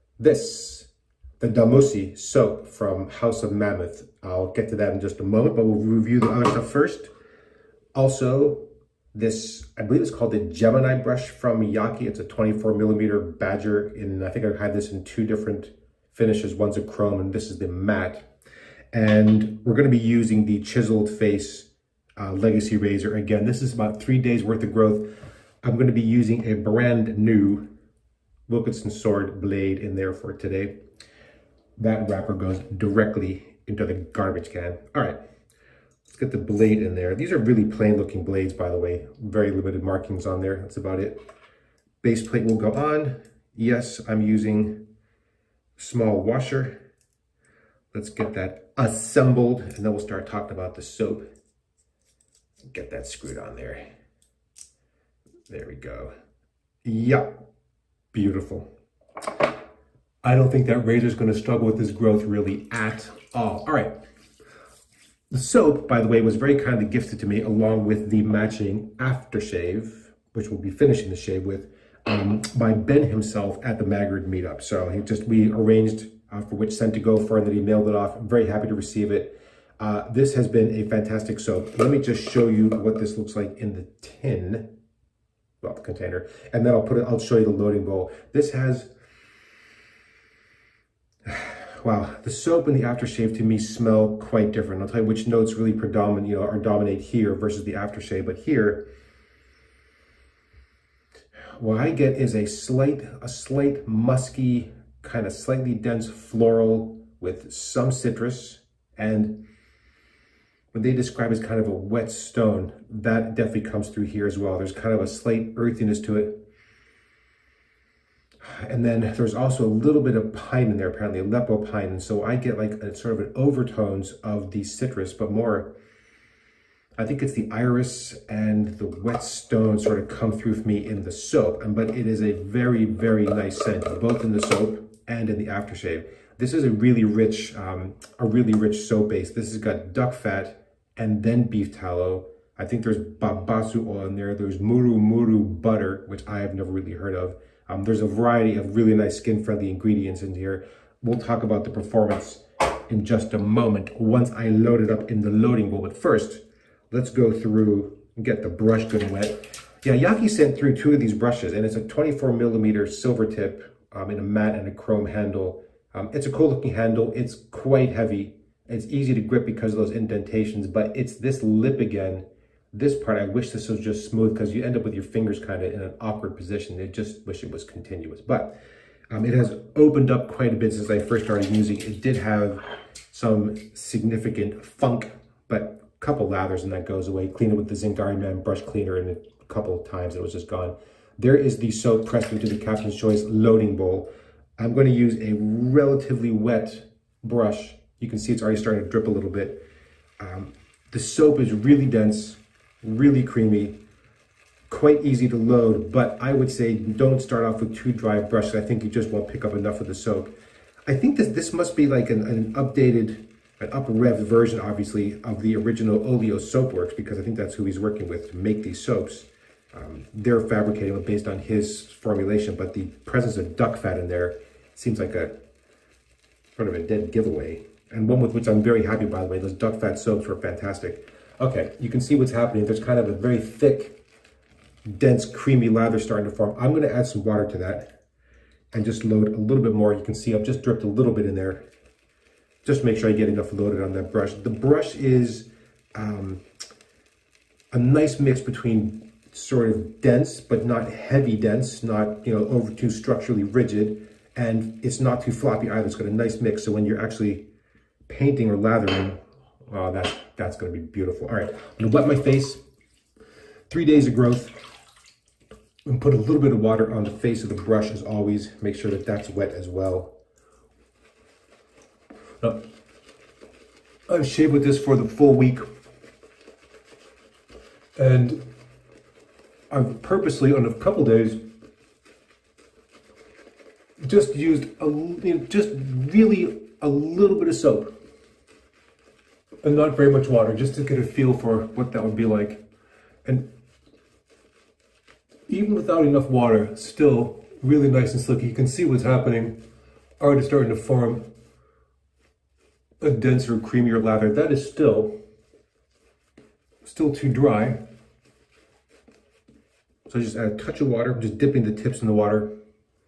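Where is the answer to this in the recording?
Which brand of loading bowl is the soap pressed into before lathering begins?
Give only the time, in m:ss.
3:12.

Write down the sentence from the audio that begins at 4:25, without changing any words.
And put a little bit of water on the face of the brush as always.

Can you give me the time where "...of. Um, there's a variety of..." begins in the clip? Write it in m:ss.
2:27.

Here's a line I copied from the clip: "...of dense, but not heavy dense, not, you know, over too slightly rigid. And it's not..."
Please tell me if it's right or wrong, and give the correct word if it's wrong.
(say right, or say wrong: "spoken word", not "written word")
wrong: "structurally", not "slightly".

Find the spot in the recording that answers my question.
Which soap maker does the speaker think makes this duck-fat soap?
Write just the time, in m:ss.
3:36.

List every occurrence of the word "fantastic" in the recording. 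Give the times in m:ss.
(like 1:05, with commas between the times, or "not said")
1:20, 3:50.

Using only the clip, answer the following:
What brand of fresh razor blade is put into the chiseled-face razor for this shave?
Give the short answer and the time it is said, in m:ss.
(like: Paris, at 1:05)
Wilkinson Sword, at 0:28.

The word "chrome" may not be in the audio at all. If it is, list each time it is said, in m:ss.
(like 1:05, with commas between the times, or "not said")
0:16, 2:44.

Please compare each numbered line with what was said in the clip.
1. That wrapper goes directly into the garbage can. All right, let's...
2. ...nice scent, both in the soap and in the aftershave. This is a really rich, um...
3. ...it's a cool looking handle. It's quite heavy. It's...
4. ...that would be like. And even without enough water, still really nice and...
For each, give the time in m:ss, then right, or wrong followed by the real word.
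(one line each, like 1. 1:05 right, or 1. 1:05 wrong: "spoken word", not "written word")
1. 0:31 right
2. 2:13 right
3. 2:46 right
4. 4:51 right.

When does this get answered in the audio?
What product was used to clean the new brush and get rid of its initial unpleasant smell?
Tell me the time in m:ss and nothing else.
3:07.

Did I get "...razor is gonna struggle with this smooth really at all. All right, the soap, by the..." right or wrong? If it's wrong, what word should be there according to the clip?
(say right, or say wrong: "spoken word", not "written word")
wrong: "growth", not "smooth".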